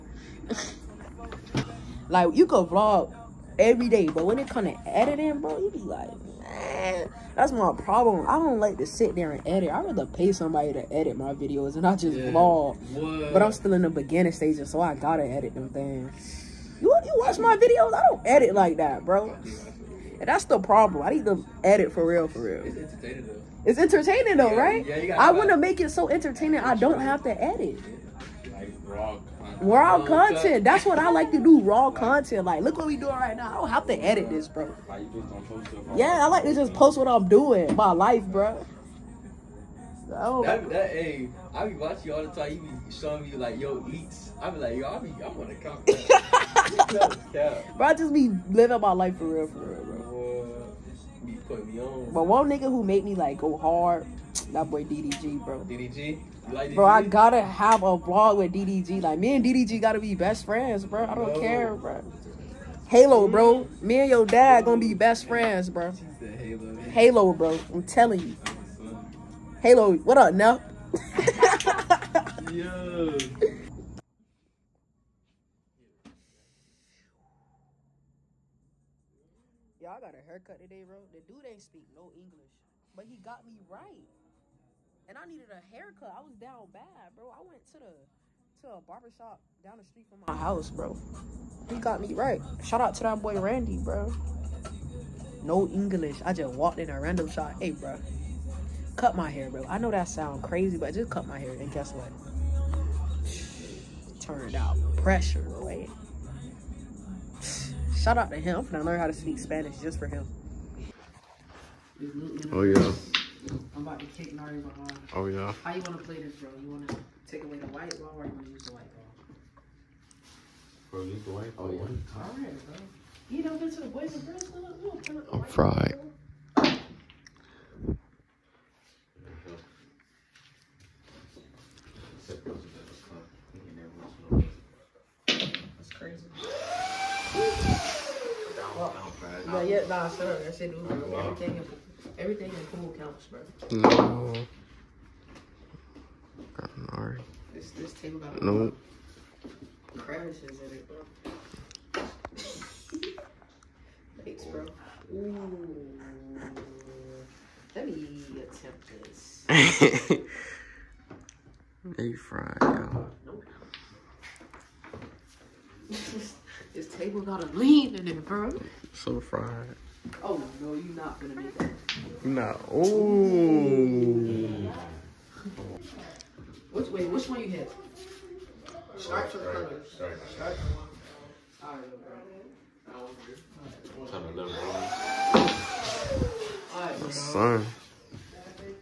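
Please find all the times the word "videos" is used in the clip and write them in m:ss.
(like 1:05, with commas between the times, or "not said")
0:11, 0:17.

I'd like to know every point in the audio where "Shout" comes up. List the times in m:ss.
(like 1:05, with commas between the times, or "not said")
1:32, 1:48.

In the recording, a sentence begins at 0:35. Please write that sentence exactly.
Yeah, I like to just post what I'm doing.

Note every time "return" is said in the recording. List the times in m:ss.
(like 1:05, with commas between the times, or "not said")
not said.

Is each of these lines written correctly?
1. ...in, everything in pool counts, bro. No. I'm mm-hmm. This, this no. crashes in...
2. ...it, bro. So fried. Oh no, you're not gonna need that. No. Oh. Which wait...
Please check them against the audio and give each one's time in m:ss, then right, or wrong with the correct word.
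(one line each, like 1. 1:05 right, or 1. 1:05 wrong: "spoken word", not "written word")
1. 2:21 right
2. 2:48 right.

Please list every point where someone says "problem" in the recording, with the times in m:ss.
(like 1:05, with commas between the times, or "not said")
0:07, 0:20.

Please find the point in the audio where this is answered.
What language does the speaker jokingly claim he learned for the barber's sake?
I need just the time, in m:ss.
1:49.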